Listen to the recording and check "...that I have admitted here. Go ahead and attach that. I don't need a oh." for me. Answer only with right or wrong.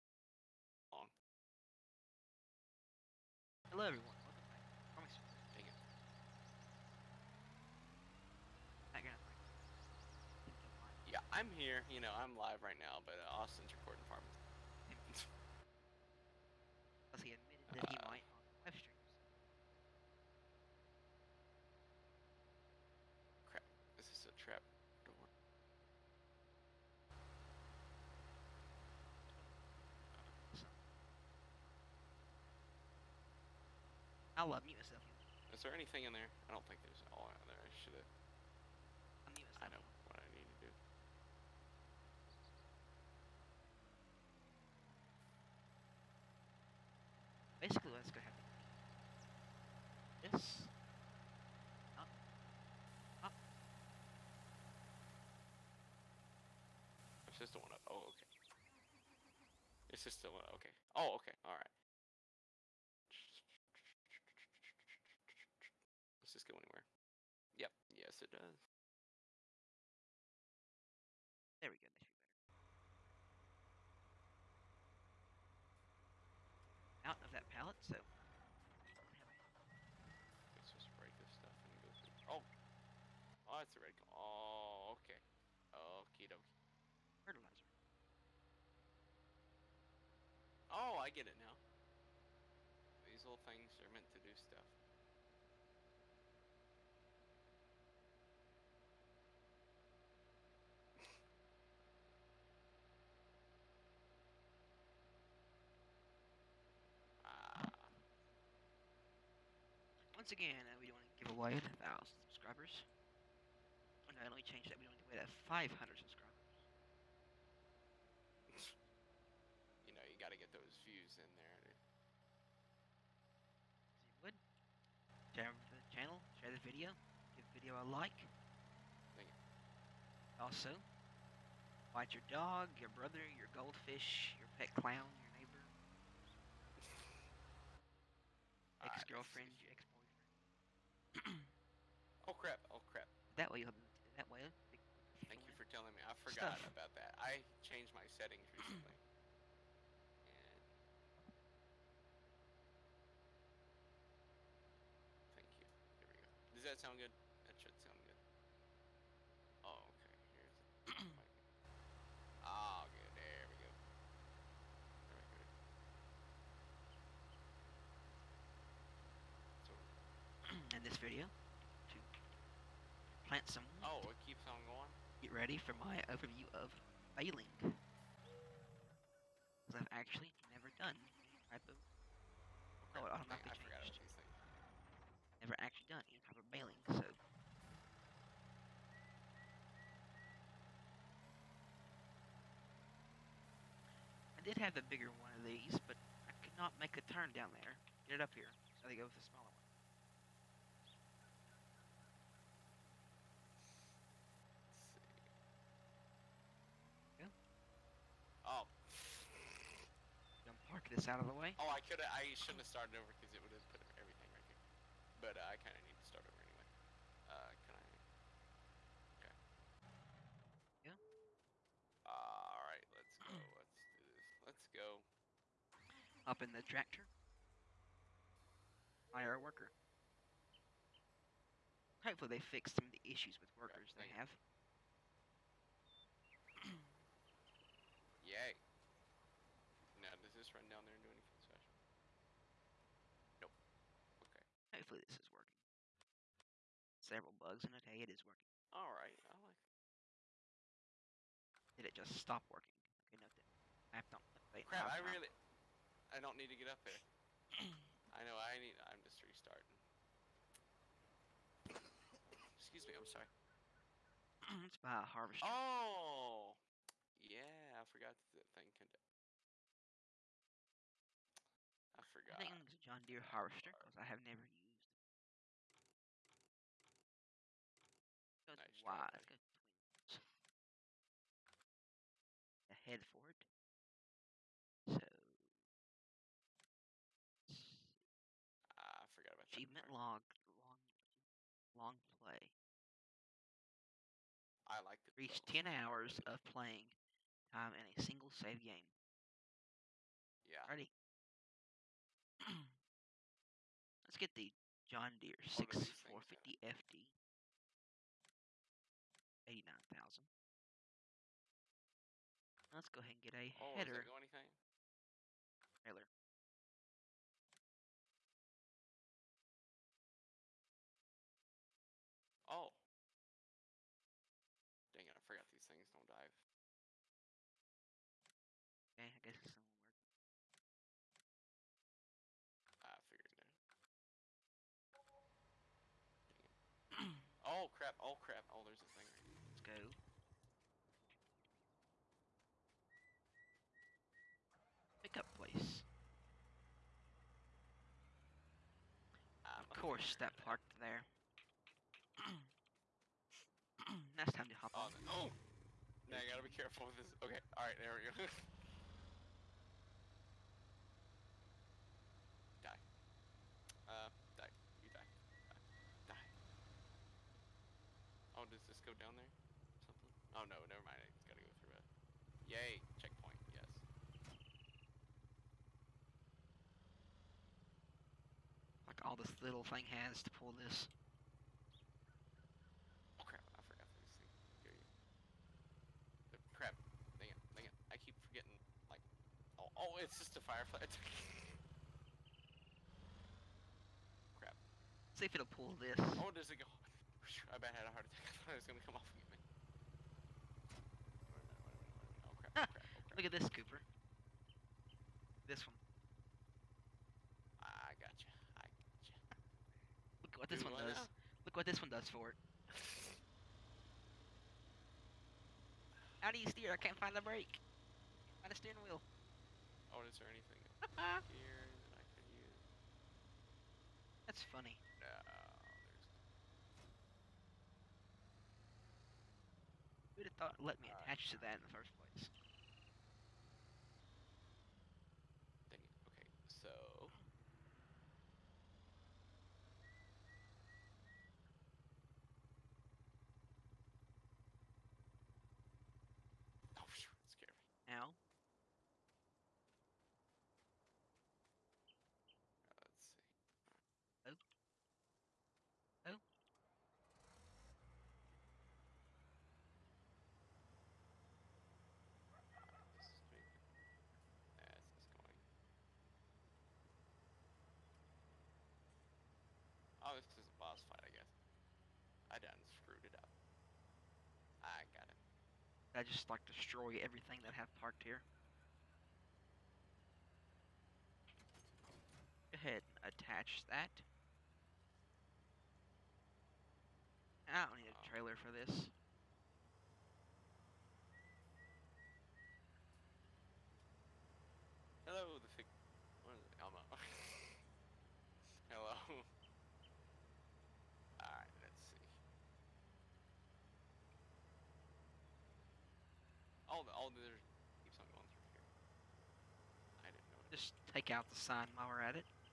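wrong.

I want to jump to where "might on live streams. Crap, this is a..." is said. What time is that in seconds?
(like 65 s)
18 s.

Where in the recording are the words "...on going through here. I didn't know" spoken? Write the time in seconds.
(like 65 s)
507 s.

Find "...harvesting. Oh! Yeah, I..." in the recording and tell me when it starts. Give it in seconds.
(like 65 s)
265 s.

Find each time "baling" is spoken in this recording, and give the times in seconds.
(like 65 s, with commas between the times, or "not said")
177 s, 186 s.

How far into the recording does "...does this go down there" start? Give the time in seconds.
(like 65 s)
368 s.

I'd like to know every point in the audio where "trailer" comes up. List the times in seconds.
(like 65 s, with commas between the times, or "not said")
315 s, 488 s.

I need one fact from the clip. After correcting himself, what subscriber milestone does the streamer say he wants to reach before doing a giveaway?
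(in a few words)
500.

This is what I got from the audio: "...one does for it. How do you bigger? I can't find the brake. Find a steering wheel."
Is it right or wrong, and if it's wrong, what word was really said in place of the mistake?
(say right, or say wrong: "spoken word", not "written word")
wrong: "steer", not "bigger".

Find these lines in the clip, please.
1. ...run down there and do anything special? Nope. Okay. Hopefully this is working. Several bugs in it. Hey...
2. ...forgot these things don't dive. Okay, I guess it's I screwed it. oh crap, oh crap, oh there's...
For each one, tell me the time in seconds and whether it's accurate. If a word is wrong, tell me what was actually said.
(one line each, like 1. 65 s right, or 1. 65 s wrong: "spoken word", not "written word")
1. 240 s right
2. 325 s wrong: "figured", not "screwed".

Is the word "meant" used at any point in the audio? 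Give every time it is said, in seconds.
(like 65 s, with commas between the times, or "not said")
93 s.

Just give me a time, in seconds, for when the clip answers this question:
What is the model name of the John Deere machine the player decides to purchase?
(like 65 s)
305 s.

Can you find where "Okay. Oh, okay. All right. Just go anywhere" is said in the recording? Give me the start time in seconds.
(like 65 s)
60 s.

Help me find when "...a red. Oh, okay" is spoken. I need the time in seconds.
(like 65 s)
83 s.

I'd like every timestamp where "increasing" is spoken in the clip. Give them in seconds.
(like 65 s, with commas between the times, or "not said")
not said.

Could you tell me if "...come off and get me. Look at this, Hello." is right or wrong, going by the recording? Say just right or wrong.
wrong.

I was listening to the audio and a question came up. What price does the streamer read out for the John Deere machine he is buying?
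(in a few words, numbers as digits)
89,000.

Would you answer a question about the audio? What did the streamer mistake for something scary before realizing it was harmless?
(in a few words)
A firefly.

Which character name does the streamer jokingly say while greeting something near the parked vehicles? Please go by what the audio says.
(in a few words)
Elmo.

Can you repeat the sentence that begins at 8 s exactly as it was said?
Not gonna Yeah, I'm here, you know, I'm live right now, but uh, Austin's recording part.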